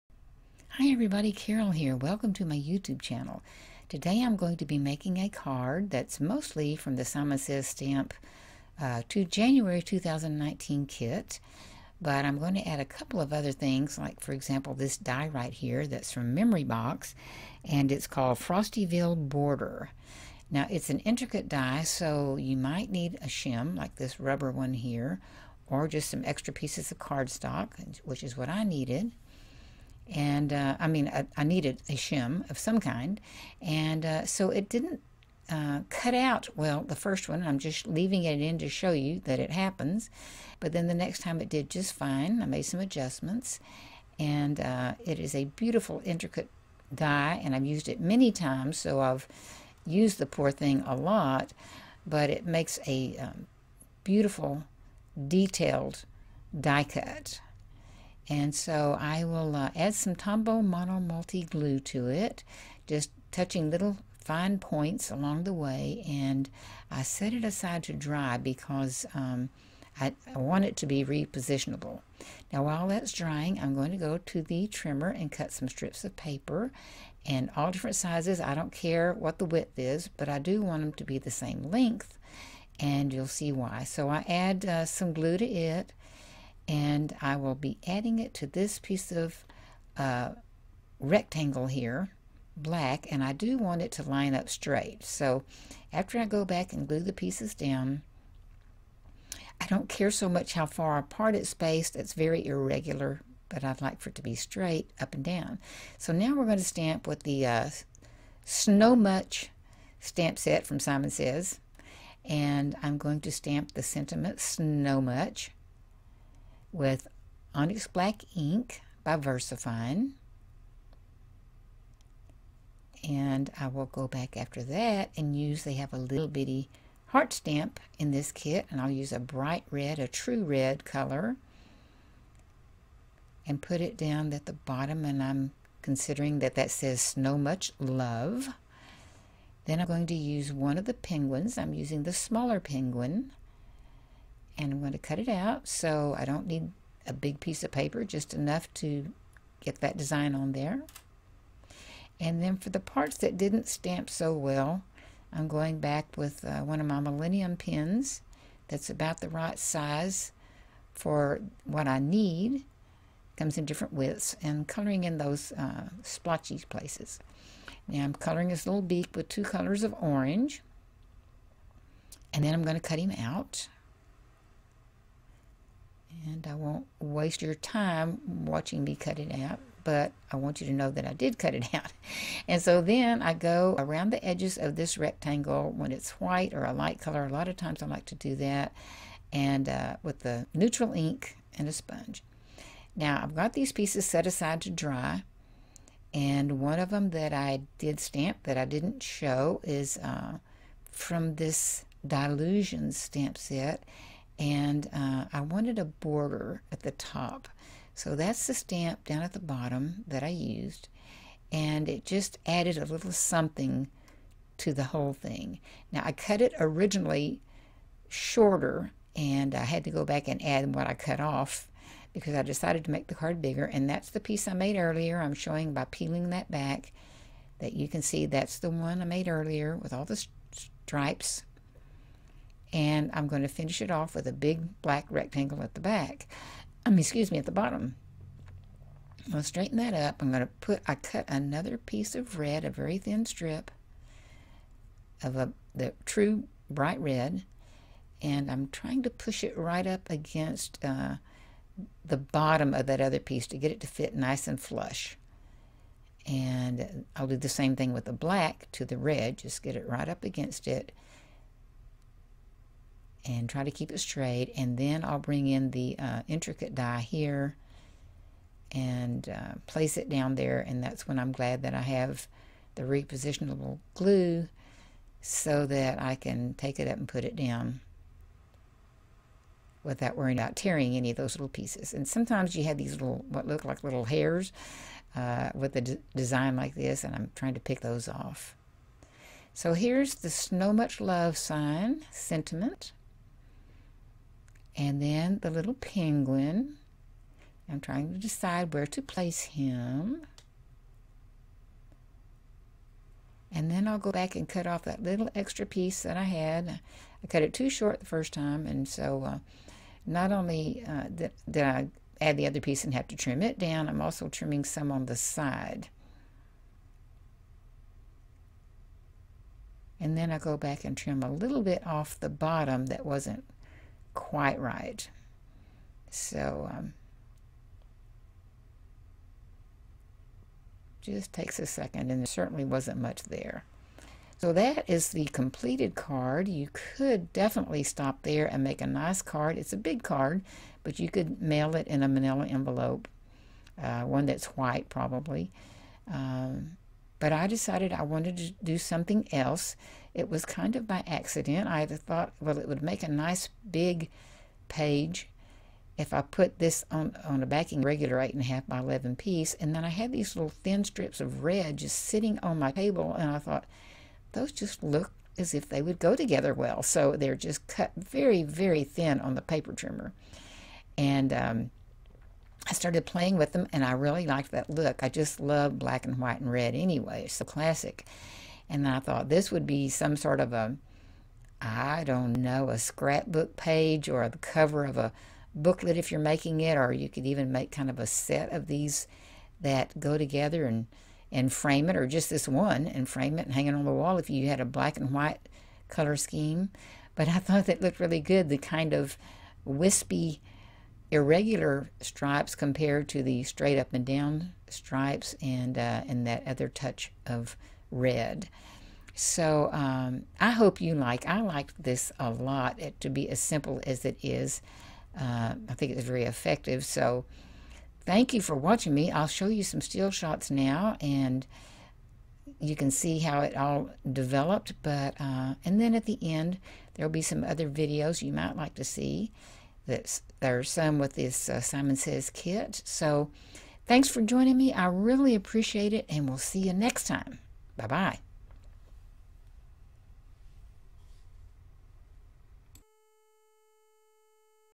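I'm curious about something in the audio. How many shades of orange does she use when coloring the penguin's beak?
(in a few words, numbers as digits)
2.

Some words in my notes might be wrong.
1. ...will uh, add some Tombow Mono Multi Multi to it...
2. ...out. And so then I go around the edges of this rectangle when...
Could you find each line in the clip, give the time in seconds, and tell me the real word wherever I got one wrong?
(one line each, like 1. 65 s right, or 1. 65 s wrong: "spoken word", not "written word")
1. 59 s wrong: "Glue", not "Multi"
2. 181 s right.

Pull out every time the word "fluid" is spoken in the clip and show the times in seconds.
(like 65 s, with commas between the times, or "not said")
not said.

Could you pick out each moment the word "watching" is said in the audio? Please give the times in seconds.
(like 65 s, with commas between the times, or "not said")
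178 s, 418 s.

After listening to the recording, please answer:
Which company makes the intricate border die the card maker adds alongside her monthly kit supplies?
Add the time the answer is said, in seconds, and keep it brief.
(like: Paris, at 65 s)
Memory Box, at 16 s.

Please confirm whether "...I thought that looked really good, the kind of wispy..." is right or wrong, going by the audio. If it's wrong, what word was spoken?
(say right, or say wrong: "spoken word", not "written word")
right.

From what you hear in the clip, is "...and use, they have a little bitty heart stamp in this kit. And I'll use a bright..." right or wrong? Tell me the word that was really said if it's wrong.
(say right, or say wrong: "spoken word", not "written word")
right.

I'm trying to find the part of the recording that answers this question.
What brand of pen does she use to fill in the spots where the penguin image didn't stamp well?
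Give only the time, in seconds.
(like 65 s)
156 s.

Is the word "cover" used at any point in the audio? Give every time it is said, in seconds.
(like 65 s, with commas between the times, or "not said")
384 s.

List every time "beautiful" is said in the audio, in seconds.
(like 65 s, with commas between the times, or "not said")
45 s, 54 s.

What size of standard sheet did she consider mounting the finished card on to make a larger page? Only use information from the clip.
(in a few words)
8.5 by 11.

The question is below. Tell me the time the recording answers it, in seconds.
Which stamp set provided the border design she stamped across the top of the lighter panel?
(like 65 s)
202 s.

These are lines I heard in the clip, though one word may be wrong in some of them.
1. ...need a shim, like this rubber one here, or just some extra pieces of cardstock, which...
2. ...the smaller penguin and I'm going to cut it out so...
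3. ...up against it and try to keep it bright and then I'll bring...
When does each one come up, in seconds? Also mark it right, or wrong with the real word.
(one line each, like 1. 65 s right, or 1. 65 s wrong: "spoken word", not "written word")
1. 22 s right
2. 142 s right
3. 260 s wrong: "straight", not "bright".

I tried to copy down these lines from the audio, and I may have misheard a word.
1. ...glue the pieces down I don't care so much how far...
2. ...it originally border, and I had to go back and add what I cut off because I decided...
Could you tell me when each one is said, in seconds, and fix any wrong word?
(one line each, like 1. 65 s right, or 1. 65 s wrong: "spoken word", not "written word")
1. 96 s right
2. 216 s wrong: "shorter", not "border".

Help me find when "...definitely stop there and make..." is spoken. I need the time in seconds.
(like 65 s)
337 s.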